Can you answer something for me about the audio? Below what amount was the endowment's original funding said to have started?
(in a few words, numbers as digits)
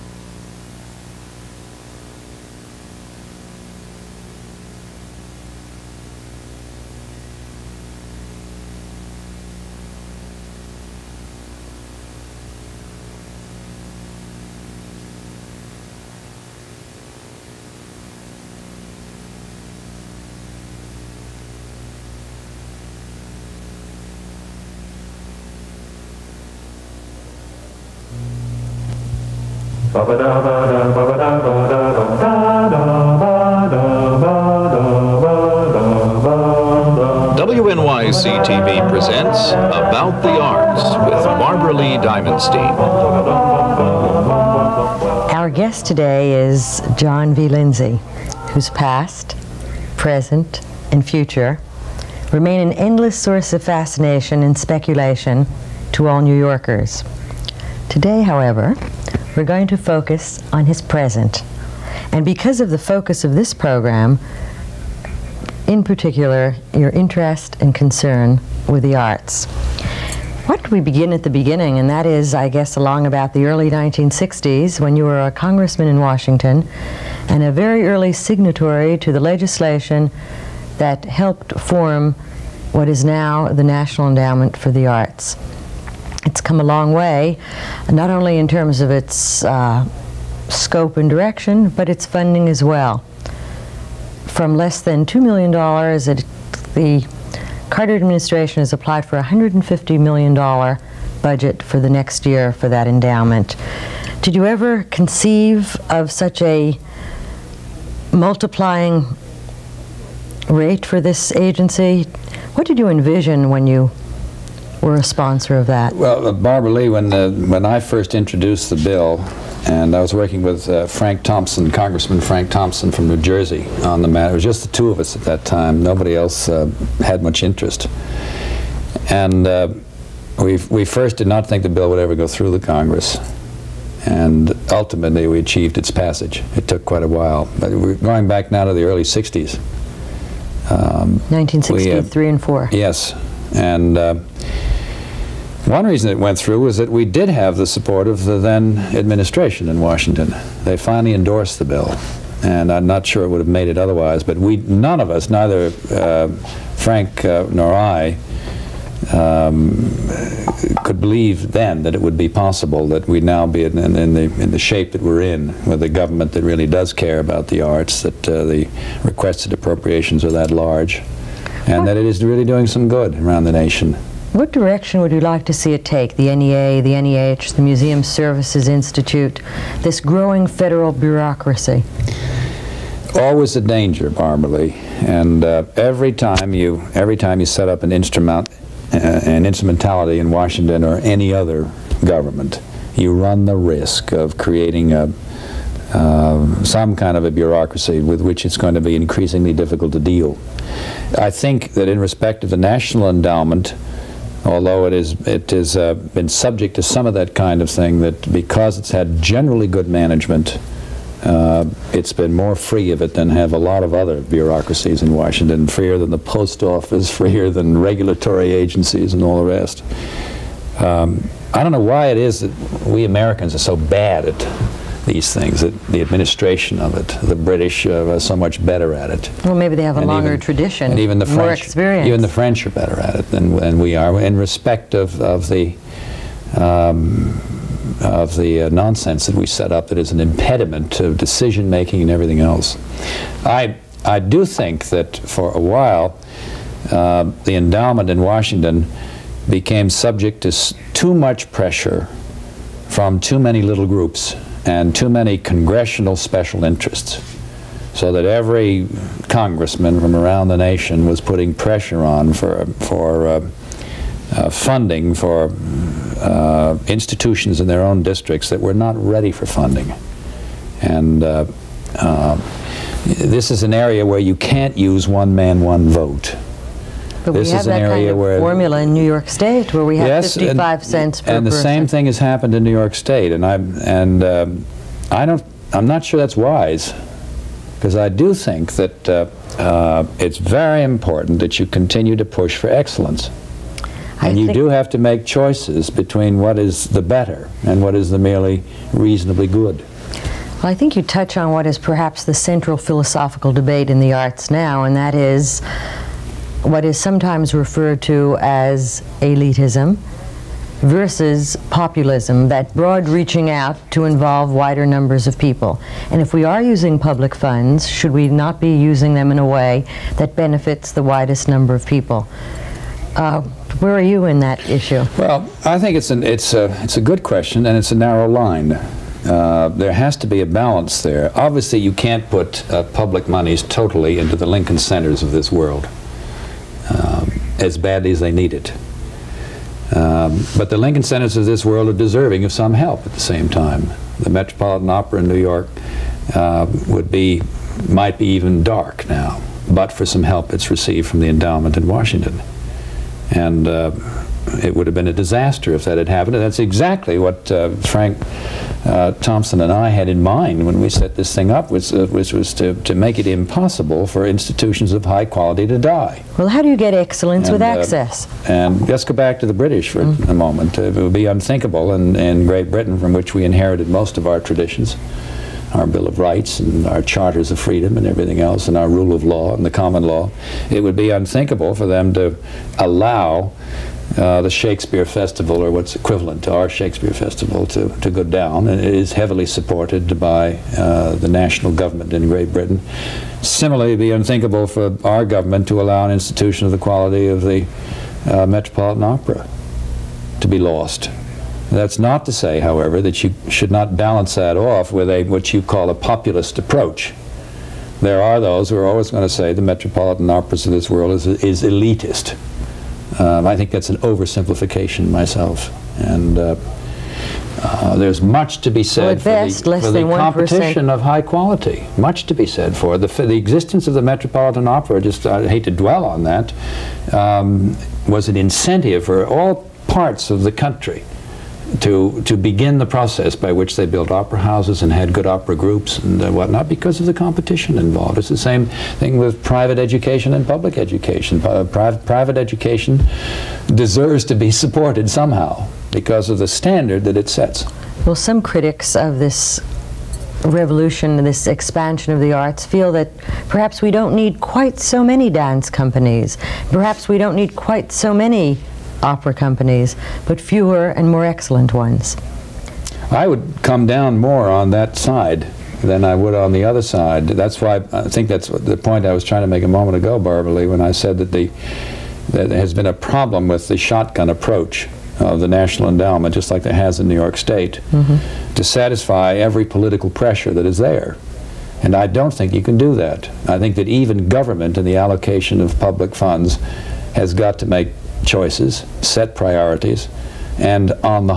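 $2 million.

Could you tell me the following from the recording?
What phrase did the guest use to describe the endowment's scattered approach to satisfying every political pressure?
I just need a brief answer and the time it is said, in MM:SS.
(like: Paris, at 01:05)
shotgun approach, at 07:53.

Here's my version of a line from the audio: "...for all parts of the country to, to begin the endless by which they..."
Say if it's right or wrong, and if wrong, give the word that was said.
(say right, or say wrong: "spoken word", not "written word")
wrong: "process", not "endless".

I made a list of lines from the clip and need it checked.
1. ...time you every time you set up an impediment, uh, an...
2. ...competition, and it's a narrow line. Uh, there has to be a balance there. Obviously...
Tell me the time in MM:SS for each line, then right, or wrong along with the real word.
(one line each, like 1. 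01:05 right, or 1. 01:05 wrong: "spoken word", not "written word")
1. 03:06 wrong: "instrument", not "impediment"
2. 05:27 wrong: "question", not "competition".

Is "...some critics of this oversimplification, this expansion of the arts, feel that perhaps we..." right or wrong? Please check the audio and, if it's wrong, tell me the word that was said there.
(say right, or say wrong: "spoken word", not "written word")
wrong: "revolution", not "oversimplification".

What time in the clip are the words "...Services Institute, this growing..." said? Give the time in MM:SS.
02:58.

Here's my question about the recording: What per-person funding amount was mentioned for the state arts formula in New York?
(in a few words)
55 cents.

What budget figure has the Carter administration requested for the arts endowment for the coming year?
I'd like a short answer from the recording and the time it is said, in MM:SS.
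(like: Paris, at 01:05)
$150 million, at 01:39.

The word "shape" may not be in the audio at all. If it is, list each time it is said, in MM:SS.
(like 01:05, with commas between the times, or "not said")
02:44.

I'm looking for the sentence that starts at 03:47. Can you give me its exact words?
The British uh, are so much better at it.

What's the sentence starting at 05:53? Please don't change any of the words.
And uh, it would have been a disaster if that had happened.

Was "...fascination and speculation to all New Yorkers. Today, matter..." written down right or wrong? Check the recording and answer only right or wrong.
wrong.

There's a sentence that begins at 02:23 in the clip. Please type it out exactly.
And one reason it went through was that we did have the support of the then administration in Washington.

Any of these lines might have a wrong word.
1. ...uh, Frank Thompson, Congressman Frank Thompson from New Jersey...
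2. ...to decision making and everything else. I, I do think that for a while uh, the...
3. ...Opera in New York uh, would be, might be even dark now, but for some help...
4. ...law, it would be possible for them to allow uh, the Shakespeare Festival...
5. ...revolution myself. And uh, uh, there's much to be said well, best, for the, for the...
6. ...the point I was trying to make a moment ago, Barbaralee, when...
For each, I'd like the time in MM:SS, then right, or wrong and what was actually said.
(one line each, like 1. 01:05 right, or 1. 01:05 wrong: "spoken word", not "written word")
1. 02:00 right
2. 04:00 right
3. 05:44 right
4. 06:20 wrong: "unthinkable", not "possible"
5. 06:53 wrong: "oversimplification", not "revolution"
6. 07:48 right.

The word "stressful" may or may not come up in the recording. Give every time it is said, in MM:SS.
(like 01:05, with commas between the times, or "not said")
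not said.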